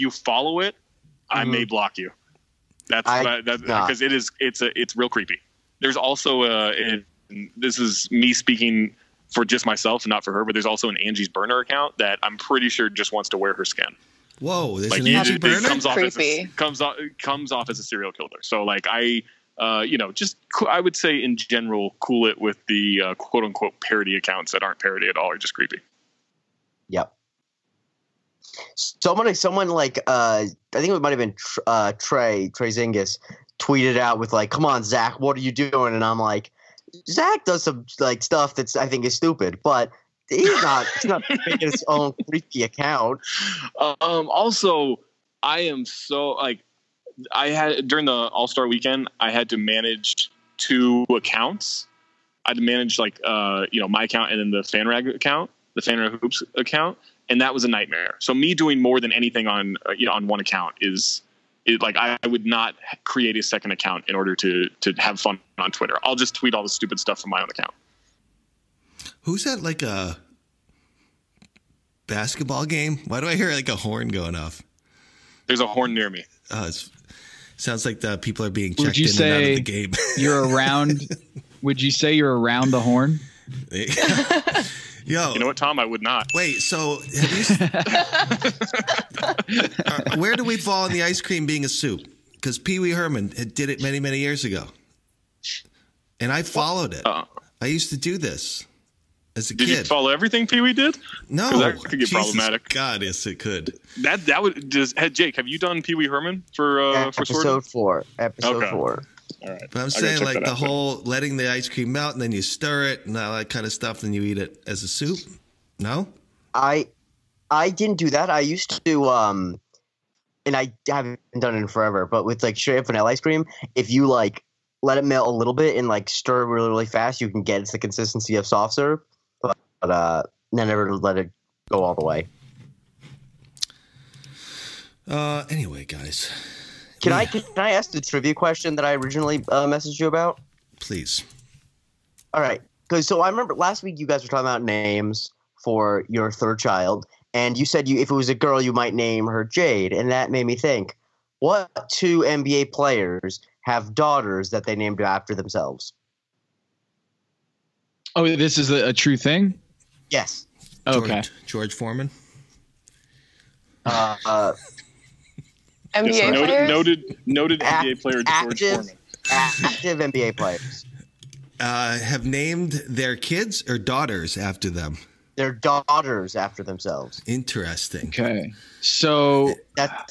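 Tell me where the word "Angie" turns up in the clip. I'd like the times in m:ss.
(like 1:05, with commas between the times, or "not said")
0:10, 0:15.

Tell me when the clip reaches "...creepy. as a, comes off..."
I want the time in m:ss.
0:15.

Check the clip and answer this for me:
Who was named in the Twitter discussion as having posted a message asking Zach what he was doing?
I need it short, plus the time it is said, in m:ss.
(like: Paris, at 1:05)
Trey Zingis, at 0:32.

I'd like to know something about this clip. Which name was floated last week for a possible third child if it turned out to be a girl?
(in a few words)
Jade.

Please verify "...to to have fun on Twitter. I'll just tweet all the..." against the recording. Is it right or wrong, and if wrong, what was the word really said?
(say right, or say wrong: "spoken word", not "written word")
right.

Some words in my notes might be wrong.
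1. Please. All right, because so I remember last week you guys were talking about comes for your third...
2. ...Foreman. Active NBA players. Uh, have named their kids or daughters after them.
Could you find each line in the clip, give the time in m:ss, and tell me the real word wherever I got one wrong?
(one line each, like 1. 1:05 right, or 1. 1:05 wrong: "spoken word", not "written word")
1. 2:20 wrong: "names", not "comes"
2. 2:48 right.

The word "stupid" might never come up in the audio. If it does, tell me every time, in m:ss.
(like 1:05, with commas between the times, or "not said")
0:39, 1:06.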